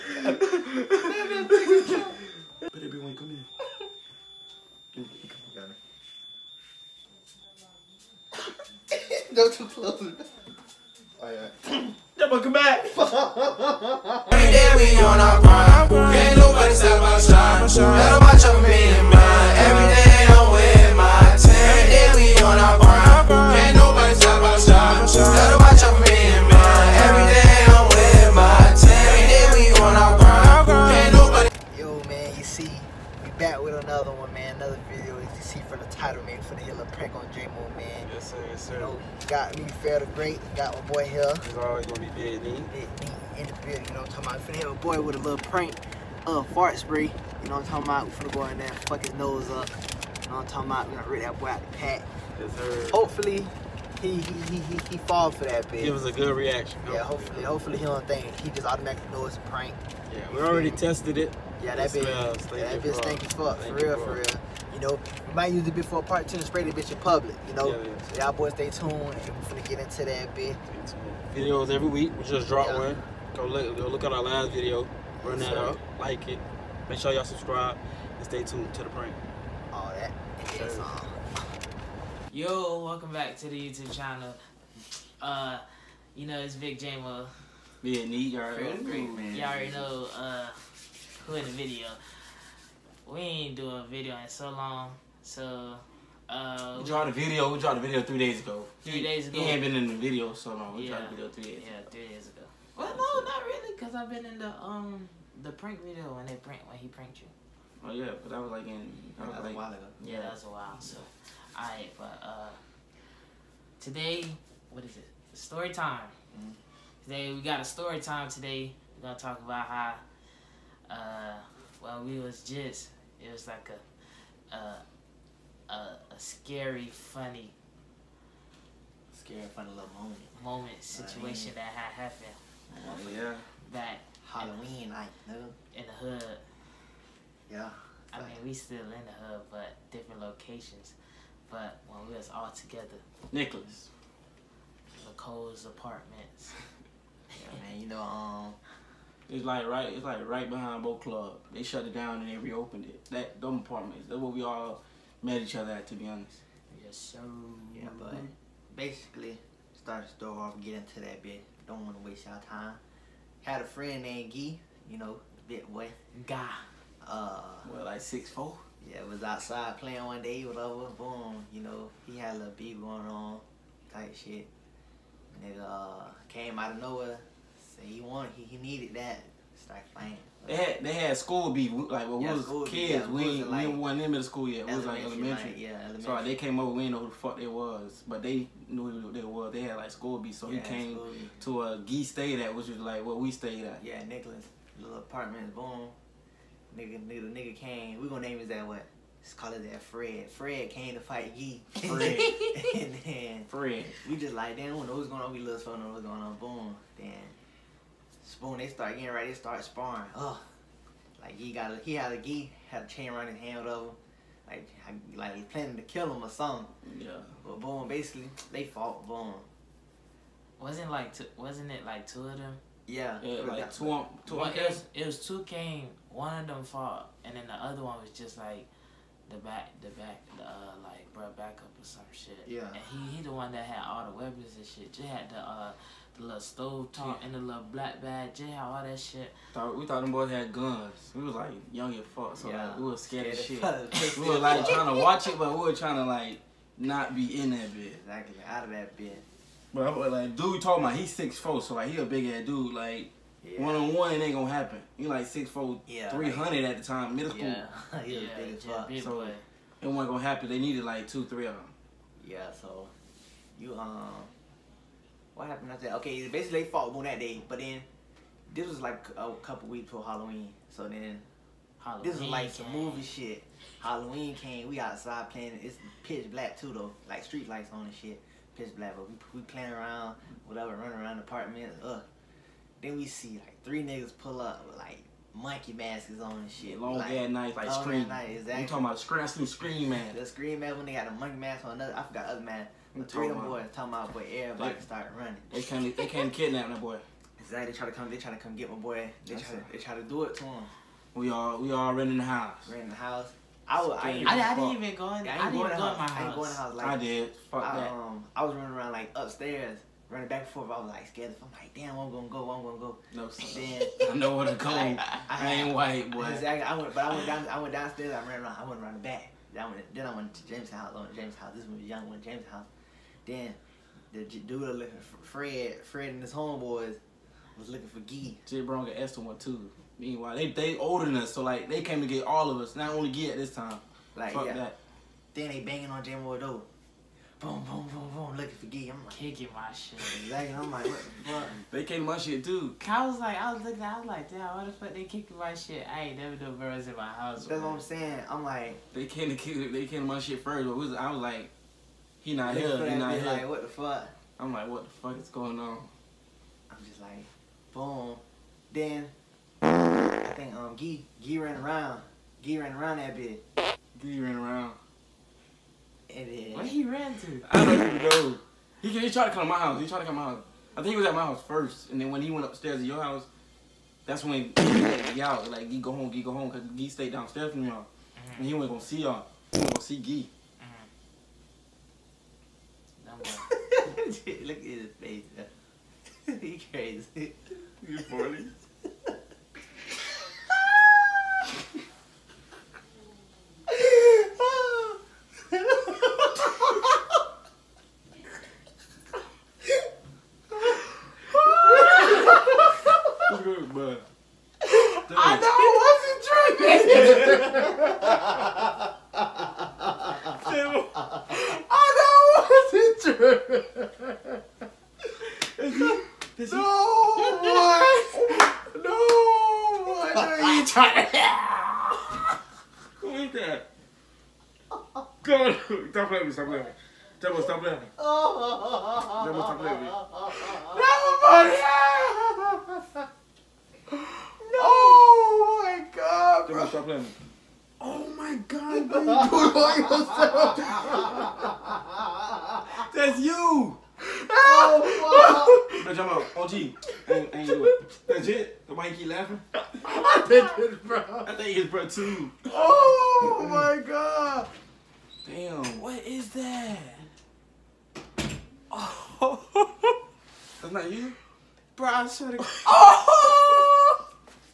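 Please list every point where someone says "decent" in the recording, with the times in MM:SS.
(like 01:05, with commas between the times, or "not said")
not said.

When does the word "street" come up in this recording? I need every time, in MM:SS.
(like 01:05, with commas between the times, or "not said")
04:37.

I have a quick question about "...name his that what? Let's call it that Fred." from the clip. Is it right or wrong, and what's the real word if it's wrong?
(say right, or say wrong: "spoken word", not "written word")
right.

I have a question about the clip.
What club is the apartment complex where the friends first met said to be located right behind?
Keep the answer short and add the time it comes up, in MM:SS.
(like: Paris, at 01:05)
Boca Club, at 02:30.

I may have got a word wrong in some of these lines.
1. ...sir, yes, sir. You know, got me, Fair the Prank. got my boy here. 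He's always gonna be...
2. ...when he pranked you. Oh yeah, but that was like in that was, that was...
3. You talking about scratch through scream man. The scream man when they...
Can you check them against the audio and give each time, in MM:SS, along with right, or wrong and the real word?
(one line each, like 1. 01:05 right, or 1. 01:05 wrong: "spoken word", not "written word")
1. 00:38 wrong: "Great", not "Prank"
2. 01:46 right
3. 04:48 right.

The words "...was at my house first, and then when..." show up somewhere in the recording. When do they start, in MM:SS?
06:10.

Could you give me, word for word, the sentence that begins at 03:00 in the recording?
They had they had school be like when yeah, we was kids.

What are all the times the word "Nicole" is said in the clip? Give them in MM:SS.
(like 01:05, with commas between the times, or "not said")
02:25.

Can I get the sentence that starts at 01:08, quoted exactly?
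We're gonna get into that bit.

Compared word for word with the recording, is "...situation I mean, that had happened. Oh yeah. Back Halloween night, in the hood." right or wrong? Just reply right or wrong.
right.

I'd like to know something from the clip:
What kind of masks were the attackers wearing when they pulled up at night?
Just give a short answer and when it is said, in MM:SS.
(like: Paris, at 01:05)
Monkey masks, at 04:45.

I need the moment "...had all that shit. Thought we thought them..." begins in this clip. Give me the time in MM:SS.
03:58.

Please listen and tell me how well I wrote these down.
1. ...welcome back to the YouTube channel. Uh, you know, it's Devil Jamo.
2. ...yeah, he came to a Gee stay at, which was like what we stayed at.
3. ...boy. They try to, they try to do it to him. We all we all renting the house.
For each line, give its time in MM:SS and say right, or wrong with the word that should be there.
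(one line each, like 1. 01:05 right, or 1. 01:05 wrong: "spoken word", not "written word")
1. 01:22 wrong: "Big", not "Devil"
2. 03:10 right
3. 04:58 right.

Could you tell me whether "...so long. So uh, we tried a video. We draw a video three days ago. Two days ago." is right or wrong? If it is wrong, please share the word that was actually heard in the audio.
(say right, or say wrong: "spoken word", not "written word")
wrong: "Three", not "Two".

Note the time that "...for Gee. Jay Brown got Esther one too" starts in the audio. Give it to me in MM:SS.
05:27.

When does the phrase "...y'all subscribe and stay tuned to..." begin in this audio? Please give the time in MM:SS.
01:17.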